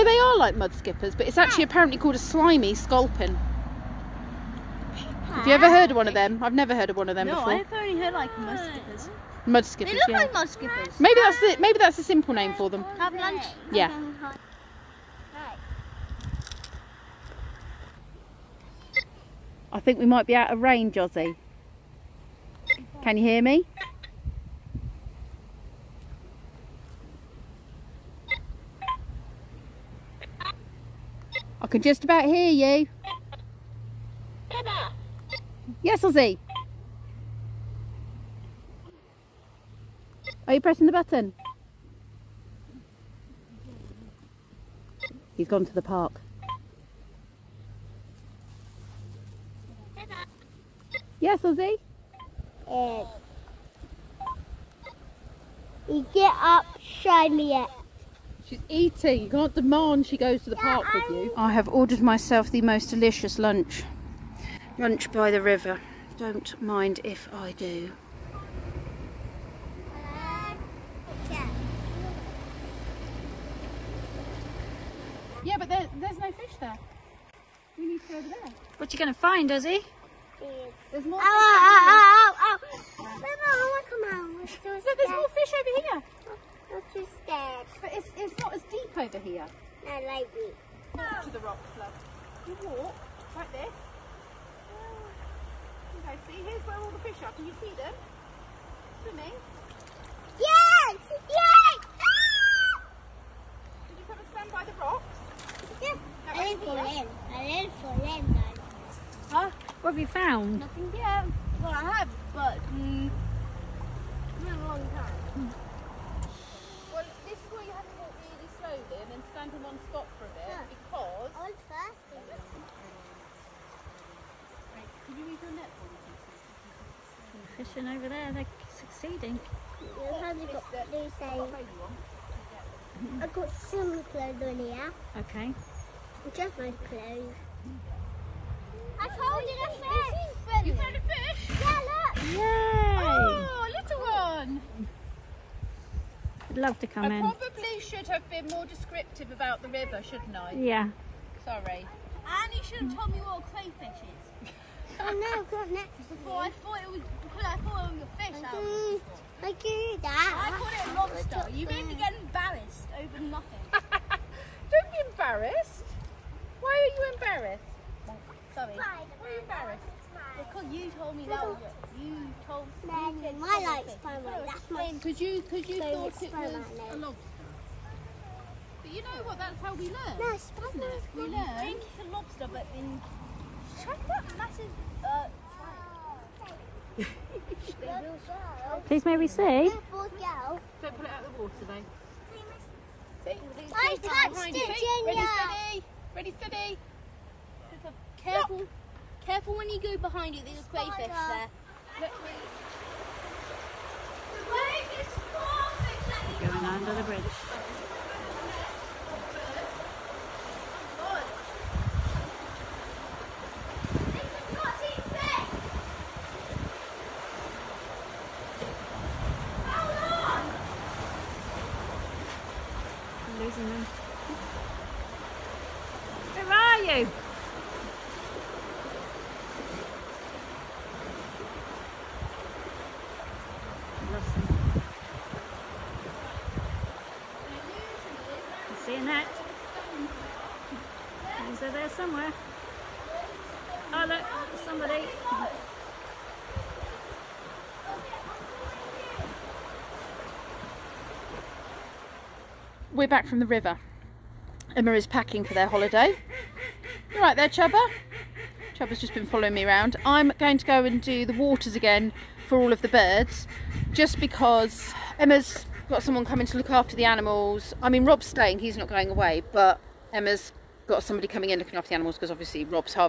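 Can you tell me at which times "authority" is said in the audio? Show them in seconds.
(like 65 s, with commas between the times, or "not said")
not said.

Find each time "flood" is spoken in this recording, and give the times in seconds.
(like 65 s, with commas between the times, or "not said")
91 s.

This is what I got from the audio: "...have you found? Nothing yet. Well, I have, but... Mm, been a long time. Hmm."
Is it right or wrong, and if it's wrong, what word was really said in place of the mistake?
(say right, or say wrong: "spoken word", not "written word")
right.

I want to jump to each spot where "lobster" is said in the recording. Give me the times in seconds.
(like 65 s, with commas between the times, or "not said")
161 s, 176 s, 182 s.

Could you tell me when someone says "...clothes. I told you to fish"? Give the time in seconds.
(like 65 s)
136 s.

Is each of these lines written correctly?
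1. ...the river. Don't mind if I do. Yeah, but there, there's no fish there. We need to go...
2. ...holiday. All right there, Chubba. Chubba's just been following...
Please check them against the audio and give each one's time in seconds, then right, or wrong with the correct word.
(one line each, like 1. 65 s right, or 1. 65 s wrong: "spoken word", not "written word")
1. 65 s right
2. 255 s right.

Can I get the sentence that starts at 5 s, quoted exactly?
Have you ever heard of one of them?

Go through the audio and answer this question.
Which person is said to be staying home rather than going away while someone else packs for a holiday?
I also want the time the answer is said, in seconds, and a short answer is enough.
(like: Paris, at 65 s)
Rob, at 268 s.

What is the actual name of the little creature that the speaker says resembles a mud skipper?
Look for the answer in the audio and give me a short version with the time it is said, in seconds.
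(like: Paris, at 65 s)
slimy sculpin, at 2 s.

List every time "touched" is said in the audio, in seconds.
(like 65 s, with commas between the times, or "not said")
194 s.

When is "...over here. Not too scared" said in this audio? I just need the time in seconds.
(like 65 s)
85 s.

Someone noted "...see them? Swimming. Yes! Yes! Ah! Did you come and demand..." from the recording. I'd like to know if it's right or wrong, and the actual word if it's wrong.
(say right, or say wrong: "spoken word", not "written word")
wrong: "stand", not "demand".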